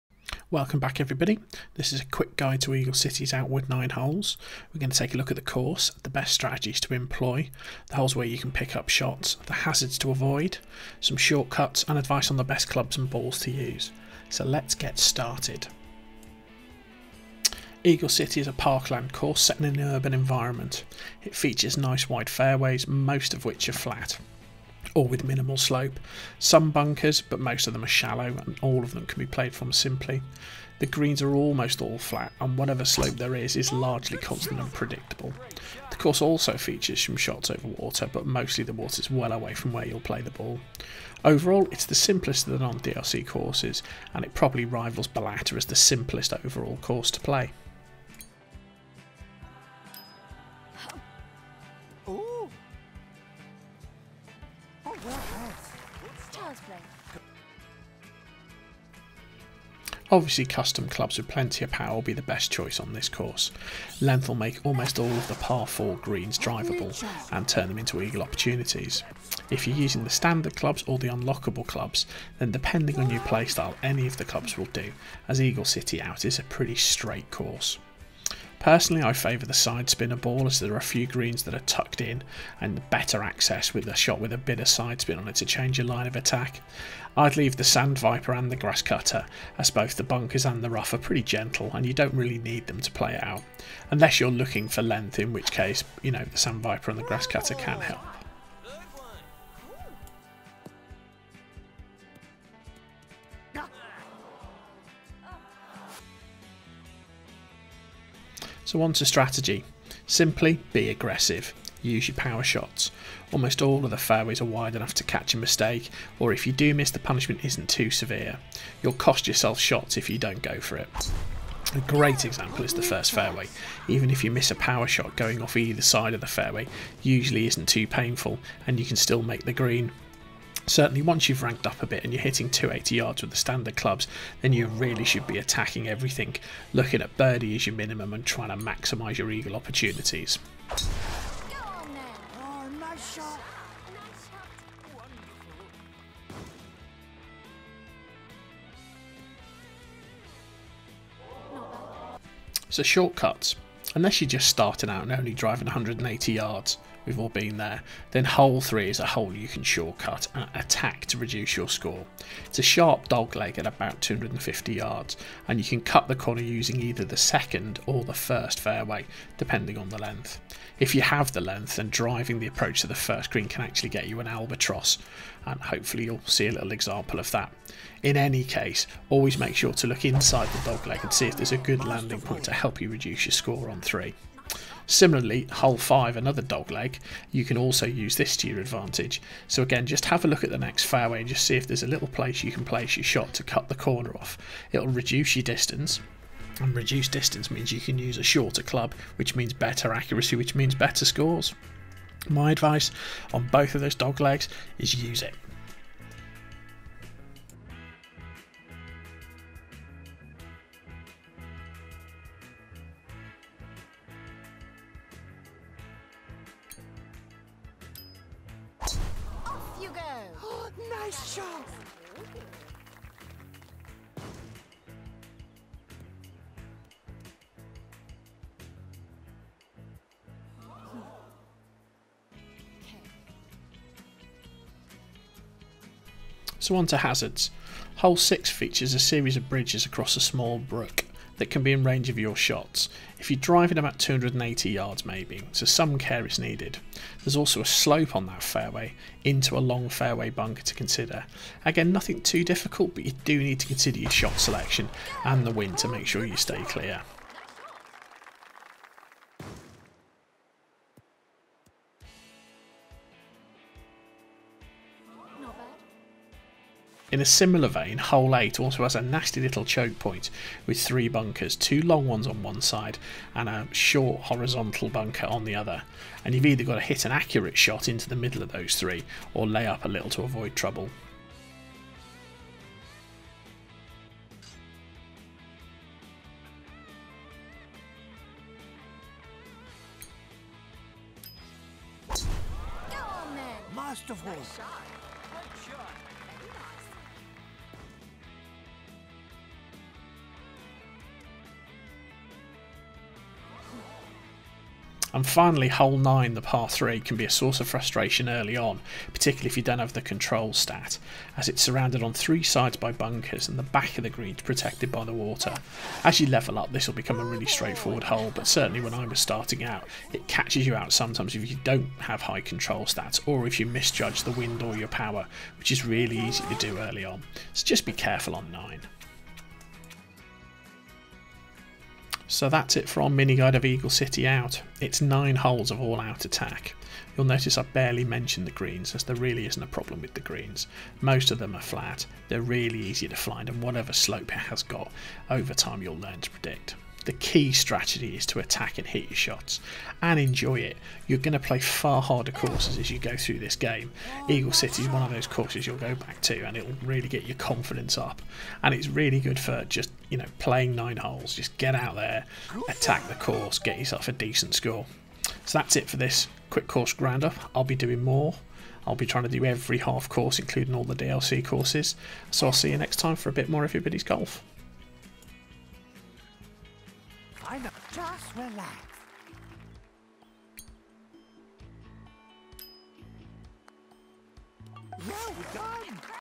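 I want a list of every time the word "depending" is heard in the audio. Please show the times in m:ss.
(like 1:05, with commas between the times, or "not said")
1:12, 2:49.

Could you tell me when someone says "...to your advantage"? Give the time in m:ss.
3:08.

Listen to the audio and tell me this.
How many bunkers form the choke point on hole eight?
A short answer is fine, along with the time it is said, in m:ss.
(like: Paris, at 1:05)
3, at 4:30.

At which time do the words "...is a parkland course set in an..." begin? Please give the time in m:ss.
0:18.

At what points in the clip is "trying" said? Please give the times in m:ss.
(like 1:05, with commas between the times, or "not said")
2:18, 6:09.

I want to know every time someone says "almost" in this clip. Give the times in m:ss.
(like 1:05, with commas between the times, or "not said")
0:31, 1:04, 1:53.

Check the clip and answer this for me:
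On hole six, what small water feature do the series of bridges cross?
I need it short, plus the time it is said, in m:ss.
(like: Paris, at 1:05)
a small brook, at 4:00.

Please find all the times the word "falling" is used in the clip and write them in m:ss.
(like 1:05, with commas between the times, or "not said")
not said.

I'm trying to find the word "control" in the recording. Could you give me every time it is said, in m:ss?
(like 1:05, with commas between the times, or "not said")
5:10, 5:22.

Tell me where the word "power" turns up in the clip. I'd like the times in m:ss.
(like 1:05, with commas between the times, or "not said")
1:01, 1:52, 2:04, 5:24.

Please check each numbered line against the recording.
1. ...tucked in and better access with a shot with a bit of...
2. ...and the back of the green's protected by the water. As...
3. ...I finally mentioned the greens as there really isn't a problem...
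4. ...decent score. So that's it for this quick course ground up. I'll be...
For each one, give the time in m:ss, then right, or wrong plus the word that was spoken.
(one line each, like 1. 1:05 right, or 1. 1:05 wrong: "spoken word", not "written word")
1. 1:21 right
2. 5:13 right
3. 5:37 wrong: "barely", not "finally"
4. 6:04 right.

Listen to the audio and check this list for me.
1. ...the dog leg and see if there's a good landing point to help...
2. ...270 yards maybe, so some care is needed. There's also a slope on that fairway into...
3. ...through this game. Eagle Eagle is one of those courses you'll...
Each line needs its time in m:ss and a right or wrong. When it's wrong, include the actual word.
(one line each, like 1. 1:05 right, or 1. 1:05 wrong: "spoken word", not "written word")
1. 3:00 right
2. 4:03 wrong: "280", not "270"
3. 5:53 wrong: "City", not "Eagle".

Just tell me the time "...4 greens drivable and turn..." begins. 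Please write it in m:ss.
1:05.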